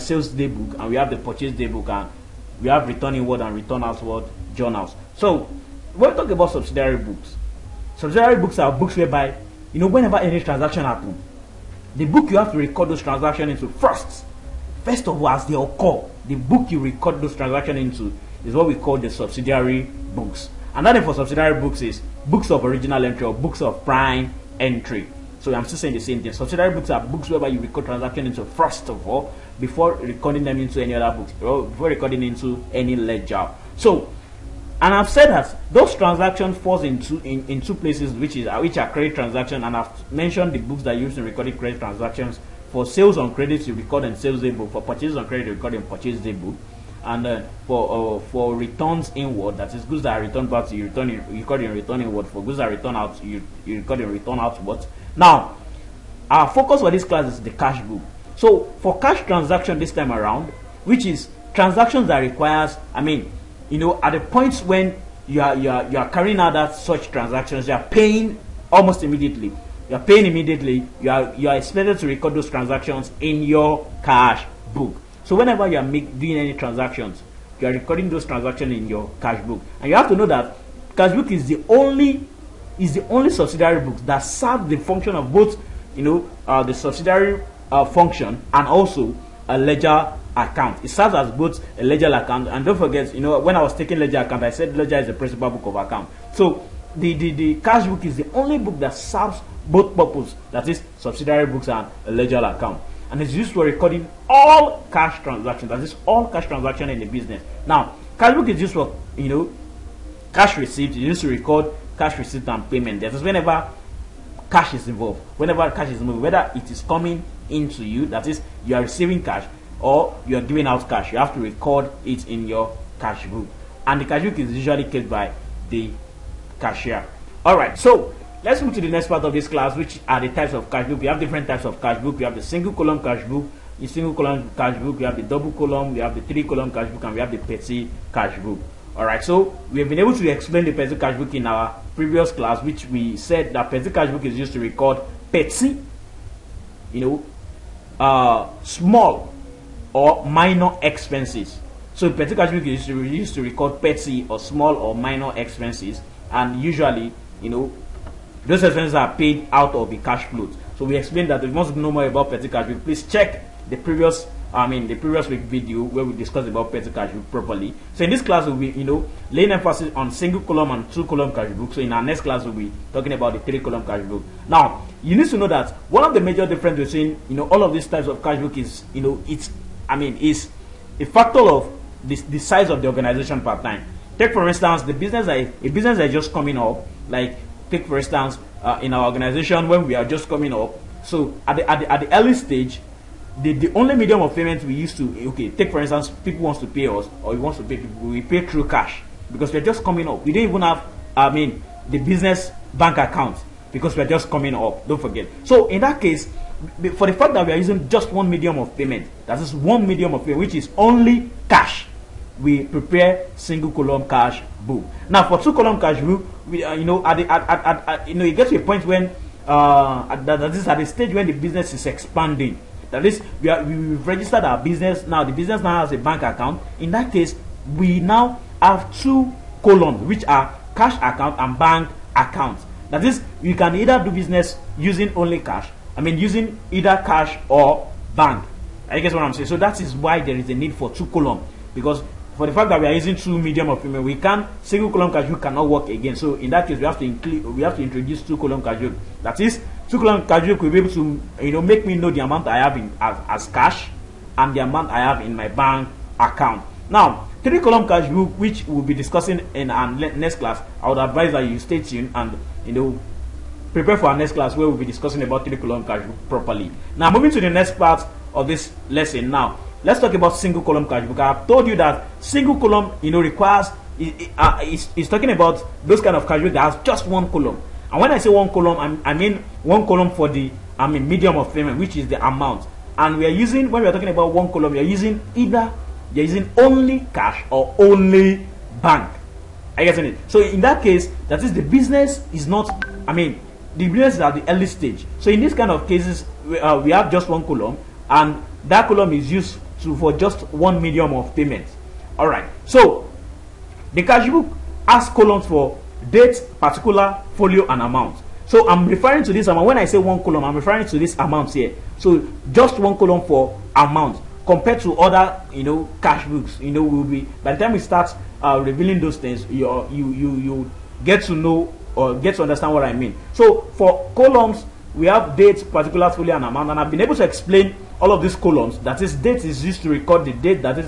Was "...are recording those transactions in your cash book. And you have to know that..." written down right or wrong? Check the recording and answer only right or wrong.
right.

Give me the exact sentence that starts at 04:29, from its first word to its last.
Let's talk about single column cash book.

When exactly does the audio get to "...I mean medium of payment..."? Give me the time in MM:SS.
04:40.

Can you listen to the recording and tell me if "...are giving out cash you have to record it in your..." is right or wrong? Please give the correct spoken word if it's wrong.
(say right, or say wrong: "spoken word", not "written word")
right.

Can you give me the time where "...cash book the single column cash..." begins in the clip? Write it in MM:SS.
02:13.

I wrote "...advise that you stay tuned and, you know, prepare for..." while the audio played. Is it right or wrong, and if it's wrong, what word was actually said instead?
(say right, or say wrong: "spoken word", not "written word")
right.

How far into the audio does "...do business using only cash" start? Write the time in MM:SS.
03:54.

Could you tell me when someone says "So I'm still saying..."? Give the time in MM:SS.
00:25.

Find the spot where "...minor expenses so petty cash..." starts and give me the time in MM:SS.
02:30.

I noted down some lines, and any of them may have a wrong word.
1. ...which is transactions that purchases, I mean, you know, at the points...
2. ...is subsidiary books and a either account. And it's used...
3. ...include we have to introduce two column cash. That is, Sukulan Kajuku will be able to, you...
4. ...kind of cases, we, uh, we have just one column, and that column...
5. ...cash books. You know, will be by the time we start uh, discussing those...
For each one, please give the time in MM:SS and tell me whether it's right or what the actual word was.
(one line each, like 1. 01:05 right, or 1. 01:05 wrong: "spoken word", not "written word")
1. 01:00 wrong: "requires", not "purchases"
2. 01:40 wrong: "ledger", not "either"
3. 04:07 right
4. 04:55 right
5. 05:16 wrong: "revealing", not "discussing".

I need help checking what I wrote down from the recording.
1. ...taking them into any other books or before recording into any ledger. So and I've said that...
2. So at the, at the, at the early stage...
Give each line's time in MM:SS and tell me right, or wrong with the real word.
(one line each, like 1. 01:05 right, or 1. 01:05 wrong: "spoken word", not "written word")
1. 00:29 wrong: "recording", not "taking"
2. 03:11 right.